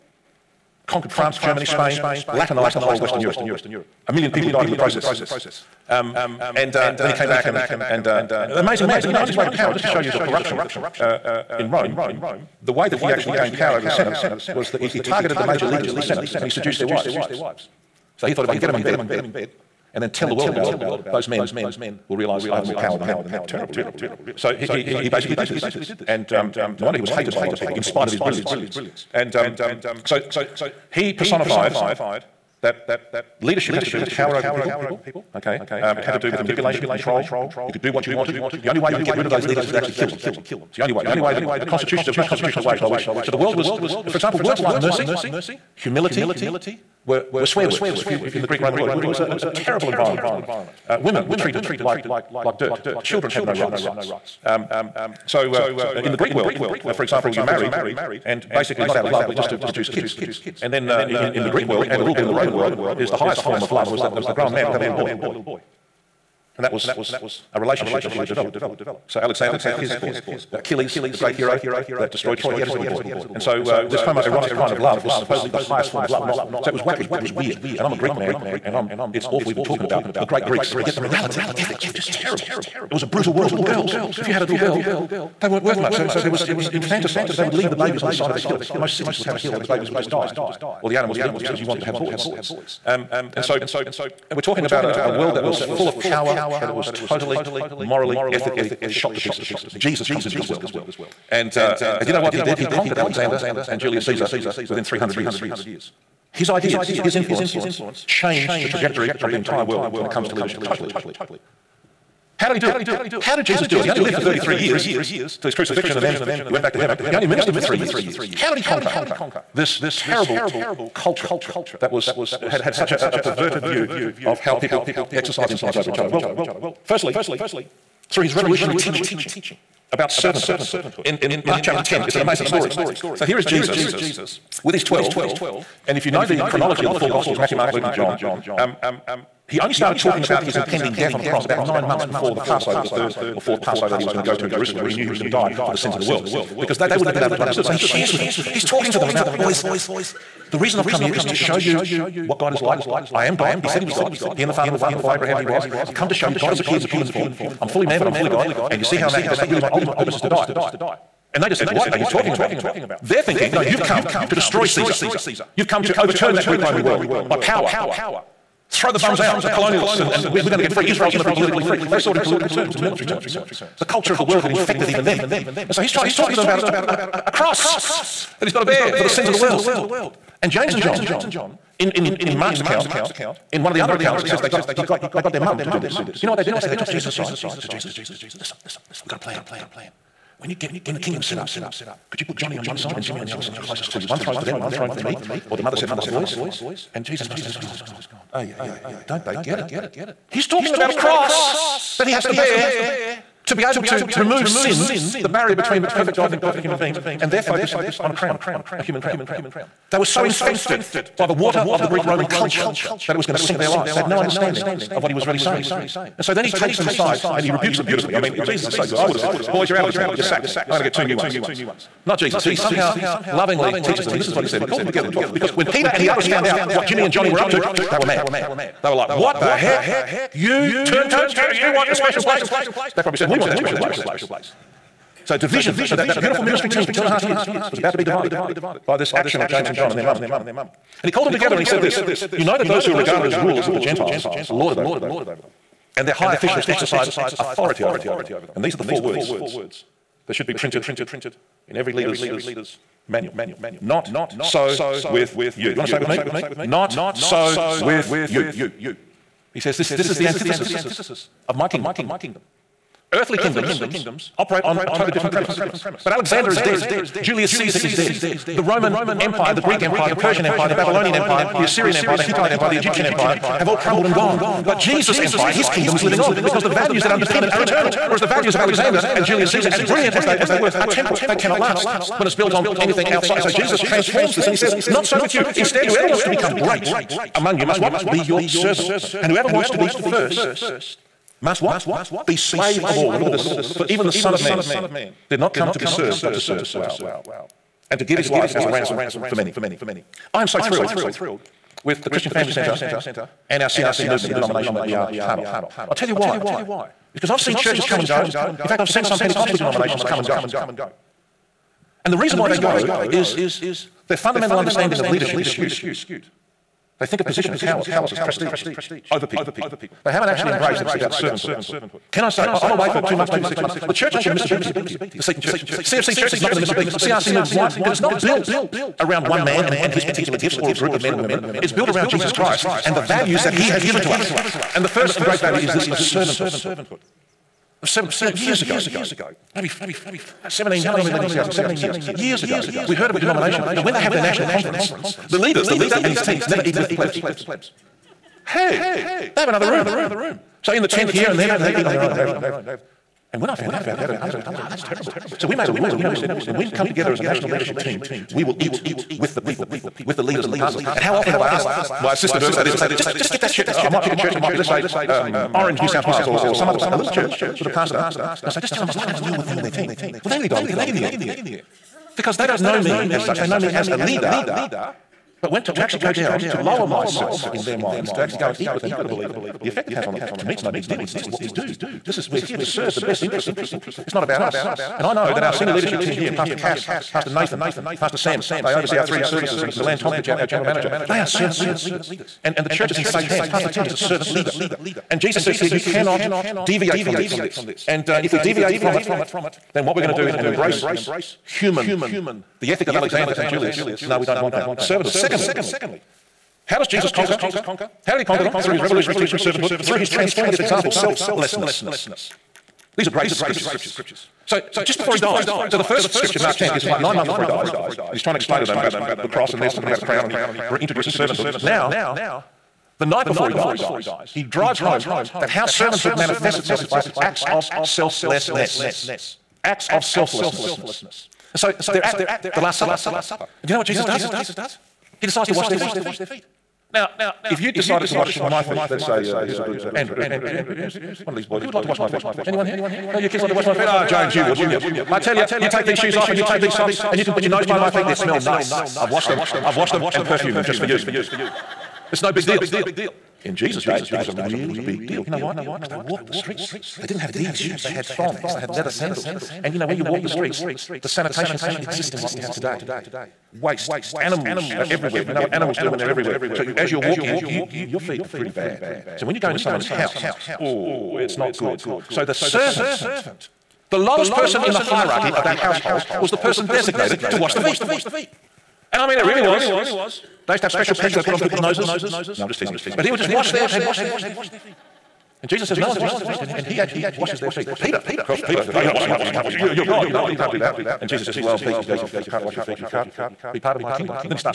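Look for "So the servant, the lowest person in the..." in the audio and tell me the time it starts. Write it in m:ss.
7:52.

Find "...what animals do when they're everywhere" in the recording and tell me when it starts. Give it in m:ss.
7:45.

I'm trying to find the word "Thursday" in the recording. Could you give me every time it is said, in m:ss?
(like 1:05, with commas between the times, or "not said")
not said.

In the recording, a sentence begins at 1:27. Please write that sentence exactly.
So they would leave the babies on the side of a hill.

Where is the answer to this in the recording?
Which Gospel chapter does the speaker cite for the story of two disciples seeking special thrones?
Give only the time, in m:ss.
2:11.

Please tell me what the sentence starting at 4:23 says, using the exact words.
Earthly kingdoms operate on a totally different premise.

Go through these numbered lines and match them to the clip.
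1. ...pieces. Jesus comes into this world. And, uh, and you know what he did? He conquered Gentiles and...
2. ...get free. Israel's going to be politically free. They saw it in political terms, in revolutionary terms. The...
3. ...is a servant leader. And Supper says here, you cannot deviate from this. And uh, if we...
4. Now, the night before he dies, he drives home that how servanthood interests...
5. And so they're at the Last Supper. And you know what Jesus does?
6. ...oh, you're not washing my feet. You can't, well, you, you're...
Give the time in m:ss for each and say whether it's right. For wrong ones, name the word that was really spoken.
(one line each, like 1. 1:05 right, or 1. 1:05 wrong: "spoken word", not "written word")
1. 1:39 wrong: "Alexander", not "Gentiles"
2. 2:50 wrong: "military", not "revolutionary"
3. 6:33 wrong: "Jesus", not "Supper"
4. 7:01 wrong: "manifests", not "interests"
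5. 7:11 right
6. 8:08 right.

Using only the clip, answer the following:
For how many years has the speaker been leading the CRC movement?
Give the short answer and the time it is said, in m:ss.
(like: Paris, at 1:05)
17, at 5:41.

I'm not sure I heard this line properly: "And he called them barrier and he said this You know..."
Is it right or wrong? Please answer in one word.
wrong.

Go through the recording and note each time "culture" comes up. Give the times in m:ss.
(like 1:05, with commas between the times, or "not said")
2:00, 2:53, 3:32.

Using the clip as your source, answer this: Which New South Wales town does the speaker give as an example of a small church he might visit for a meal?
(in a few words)
Orange.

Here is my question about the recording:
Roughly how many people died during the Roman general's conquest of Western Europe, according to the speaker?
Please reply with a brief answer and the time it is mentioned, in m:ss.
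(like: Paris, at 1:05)
A million, at 0:04.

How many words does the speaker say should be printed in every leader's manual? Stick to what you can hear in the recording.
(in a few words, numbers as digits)
4.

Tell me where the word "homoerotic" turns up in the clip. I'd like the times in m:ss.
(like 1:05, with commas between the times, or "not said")
1:14.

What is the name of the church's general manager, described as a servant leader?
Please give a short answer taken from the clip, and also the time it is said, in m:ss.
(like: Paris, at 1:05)
Milan Tompich, at 6:29.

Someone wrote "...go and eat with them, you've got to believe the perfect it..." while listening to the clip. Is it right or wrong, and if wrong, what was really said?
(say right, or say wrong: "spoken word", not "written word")
wrong: "effect", not "perfect".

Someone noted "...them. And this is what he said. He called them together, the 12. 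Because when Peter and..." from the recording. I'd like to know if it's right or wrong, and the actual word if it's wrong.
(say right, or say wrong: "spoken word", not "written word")
right.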